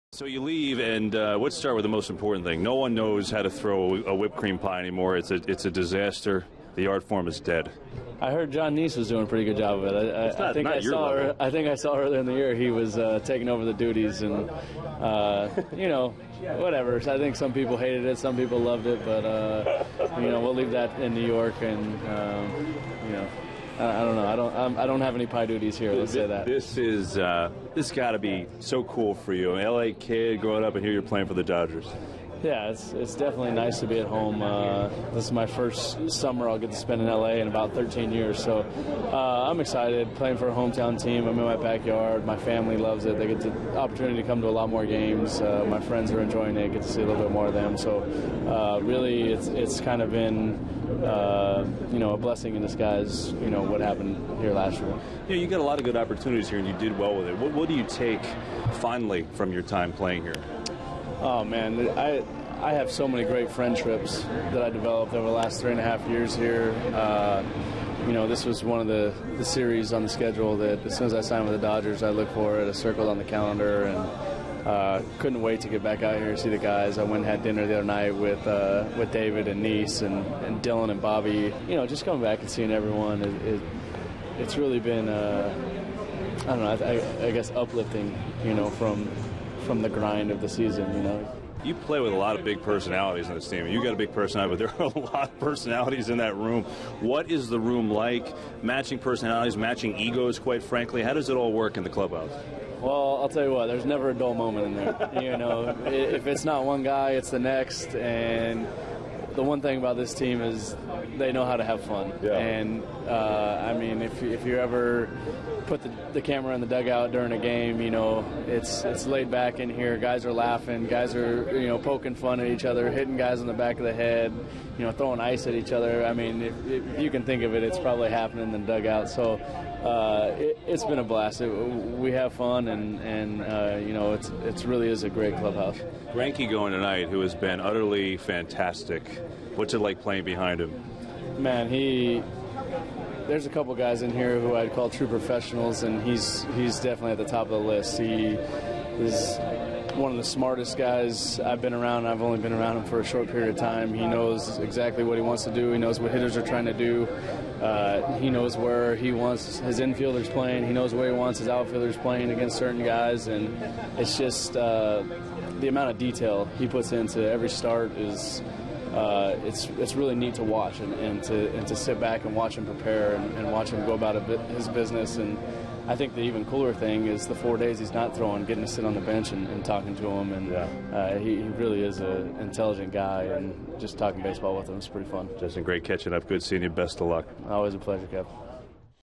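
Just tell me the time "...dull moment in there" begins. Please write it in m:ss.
1:44.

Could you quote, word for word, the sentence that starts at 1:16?
I went and had dinner the other night with uh, with David and Niese and, and Dillon and Bobby.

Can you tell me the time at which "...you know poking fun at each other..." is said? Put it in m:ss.
2:01.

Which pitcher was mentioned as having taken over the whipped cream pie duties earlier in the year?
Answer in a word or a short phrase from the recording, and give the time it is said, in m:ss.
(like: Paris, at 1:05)
Jon Niese, at 0:08.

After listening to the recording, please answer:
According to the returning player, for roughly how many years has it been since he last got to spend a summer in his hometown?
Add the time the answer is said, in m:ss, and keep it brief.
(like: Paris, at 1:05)
13, at 0:37.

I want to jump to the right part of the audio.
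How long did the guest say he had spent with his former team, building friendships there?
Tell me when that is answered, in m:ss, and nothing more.
1:05.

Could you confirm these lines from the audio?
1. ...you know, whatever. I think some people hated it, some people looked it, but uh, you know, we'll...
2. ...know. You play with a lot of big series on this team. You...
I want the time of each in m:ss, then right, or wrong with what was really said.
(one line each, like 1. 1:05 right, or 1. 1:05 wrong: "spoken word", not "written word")
1. 0:15 wrong: "loved", not "looked"
2. 1:31 wrong: "personalities", not "series".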